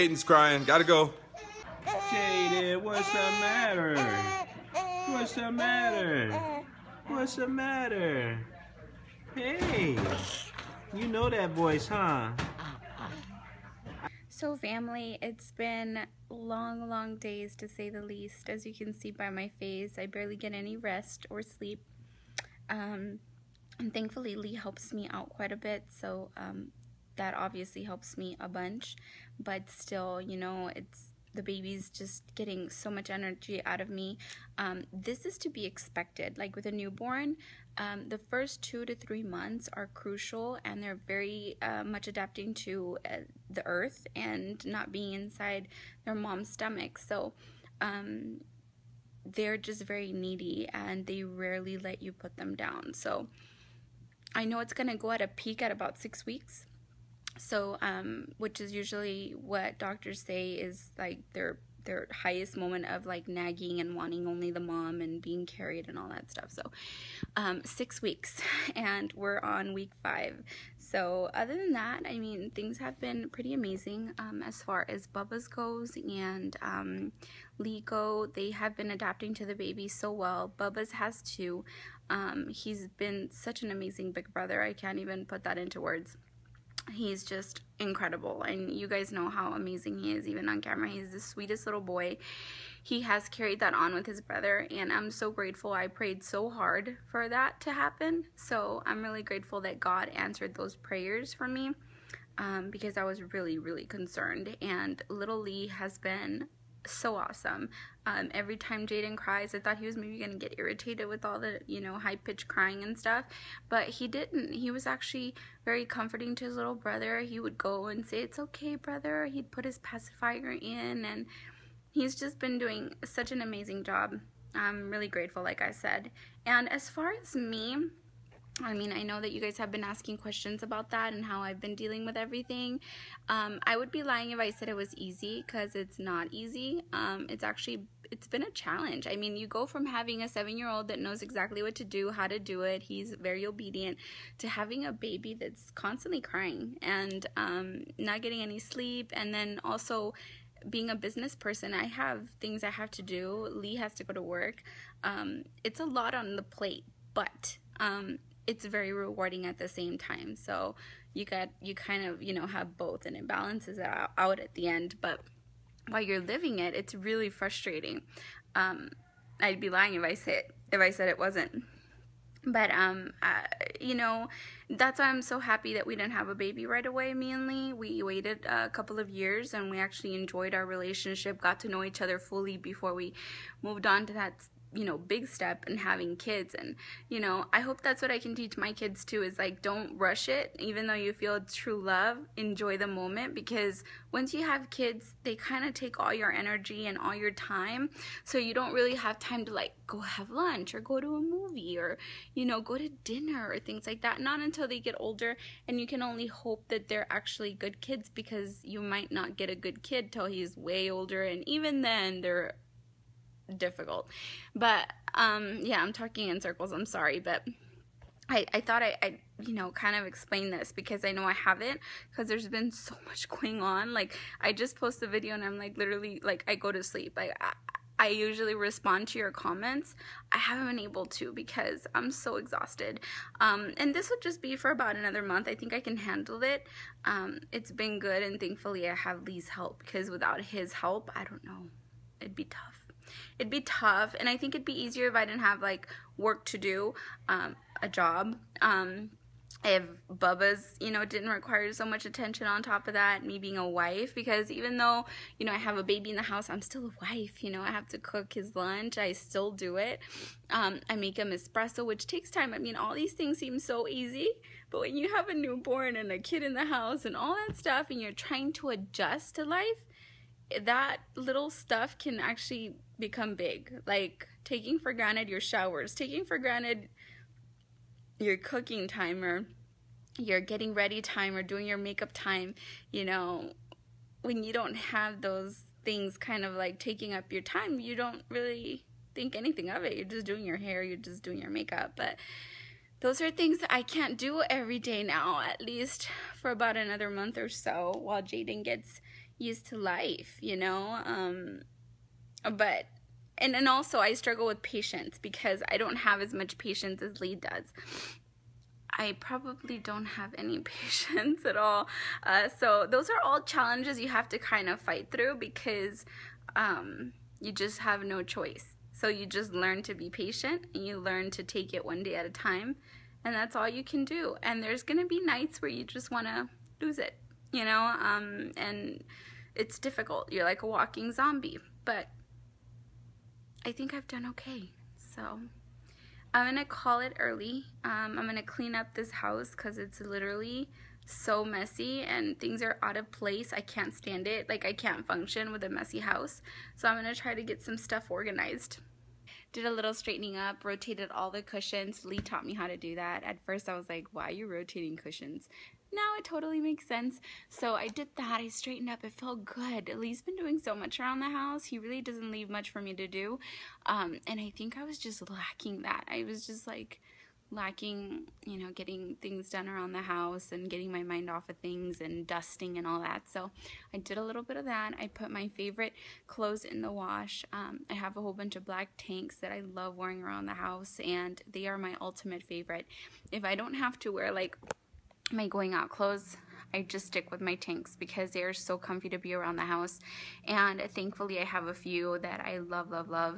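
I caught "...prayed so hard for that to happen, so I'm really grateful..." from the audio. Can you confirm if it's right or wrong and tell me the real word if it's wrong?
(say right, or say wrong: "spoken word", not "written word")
right.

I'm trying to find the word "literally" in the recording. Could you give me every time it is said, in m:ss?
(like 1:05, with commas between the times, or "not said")
3:45, 5:40.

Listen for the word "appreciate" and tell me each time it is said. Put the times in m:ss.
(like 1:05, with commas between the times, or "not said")
not said.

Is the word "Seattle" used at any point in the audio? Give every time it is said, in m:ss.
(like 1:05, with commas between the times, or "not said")
not said.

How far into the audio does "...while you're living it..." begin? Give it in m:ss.
2:45.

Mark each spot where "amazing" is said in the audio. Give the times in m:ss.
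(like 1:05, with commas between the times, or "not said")
1:13, 1:23, 1:29, 2:03.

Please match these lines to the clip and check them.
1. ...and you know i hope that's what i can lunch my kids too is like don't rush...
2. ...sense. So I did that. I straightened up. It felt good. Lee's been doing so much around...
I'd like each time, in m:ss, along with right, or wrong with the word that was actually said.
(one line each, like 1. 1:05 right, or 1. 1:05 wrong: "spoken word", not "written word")
1. 3:06 wrong: "teach", not "lunch"
2. 5:56 right.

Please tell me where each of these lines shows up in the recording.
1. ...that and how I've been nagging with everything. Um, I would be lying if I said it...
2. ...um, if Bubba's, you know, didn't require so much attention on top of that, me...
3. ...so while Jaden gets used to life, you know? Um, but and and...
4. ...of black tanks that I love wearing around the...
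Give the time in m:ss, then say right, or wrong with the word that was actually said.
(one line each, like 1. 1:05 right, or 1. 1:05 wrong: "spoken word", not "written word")
1. 2:10 wrong: "dealing", not "nagging"
2. 4:08 right
3. 4:57 right
4. 6:18 right.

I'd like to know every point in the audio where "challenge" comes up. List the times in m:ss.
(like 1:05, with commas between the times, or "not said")
2:18, 5:13.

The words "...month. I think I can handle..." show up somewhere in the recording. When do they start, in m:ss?
3:55.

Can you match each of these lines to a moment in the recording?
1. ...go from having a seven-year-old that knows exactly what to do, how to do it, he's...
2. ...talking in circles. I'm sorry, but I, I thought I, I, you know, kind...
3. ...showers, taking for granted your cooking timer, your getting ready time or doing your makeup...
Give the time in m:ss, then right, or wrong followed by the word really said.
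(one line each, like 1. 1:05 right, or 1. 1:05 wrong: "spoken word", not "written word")
1. 2:19 right
2. 3:35 right
3. 4:35 right.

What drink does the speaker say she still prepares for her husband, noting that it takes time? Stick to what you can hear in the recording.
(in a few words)
Espresso.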